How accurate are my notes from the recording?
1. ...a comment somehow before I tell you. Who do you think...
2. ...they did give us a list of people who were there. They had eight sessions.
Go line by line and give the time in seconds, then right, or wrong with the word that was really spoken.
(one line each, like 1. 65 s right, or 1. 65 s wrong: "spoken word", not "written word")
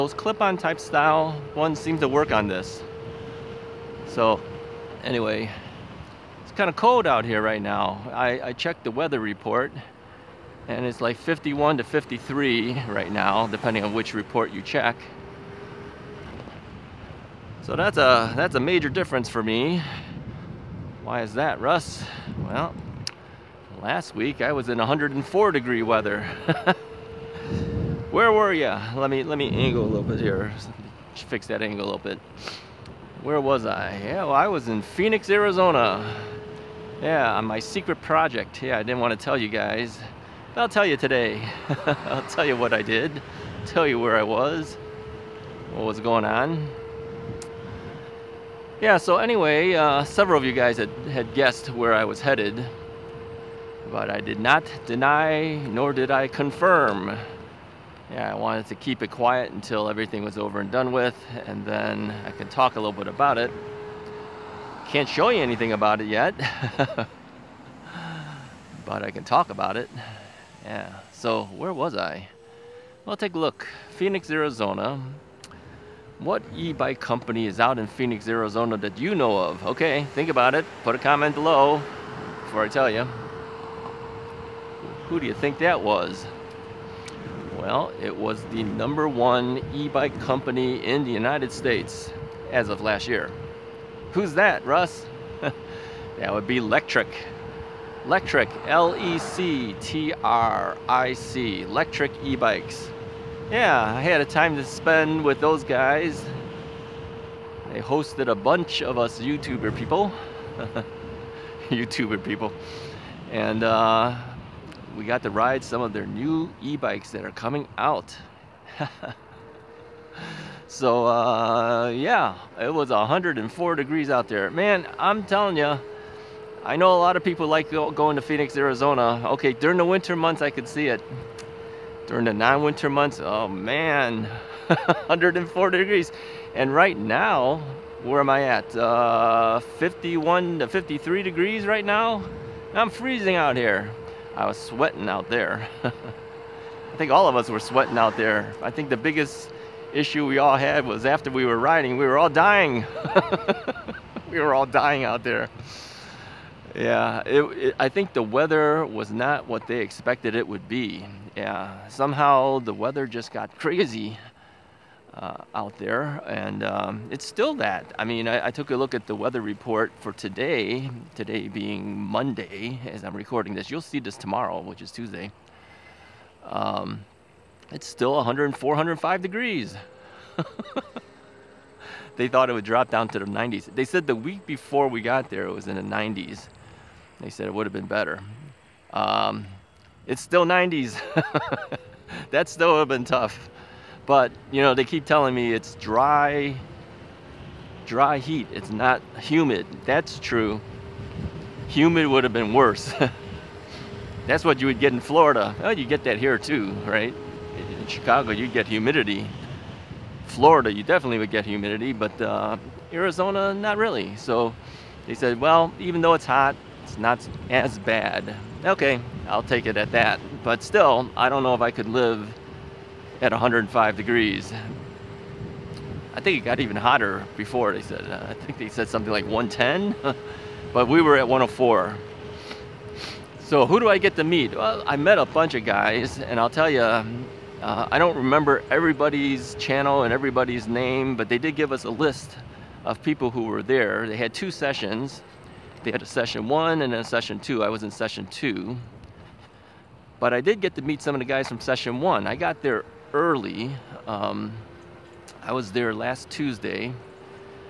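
1. 80 s wrong: "below", not "somehow"
2. 241 s wrong: "two", not "eight".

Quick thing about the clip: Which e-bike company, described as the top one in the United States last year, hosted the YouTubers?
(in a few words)
Lectric E-Bikes.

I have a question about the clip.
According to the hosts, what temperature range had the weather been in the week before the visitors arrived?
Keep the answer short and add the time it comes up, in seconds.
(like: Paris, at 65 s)
The 90s, at 185 s.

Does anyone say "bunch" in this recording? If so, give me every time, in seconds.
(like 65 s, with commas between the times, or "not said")
108 s, 235 s.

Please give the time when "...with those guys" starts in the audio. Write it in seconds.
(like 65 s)
105 s.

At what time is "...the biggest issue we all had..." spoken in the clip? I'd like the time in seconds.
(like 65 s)
148 s.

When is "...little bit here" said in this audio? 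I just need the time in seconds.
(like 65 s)
29 s.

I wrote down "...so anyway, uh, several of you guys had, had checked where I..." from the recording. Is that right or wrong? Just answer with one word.
wrong.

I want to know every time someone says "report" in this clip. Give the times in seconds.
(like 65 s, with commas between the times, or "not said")
9 s, 14 s, 169 s.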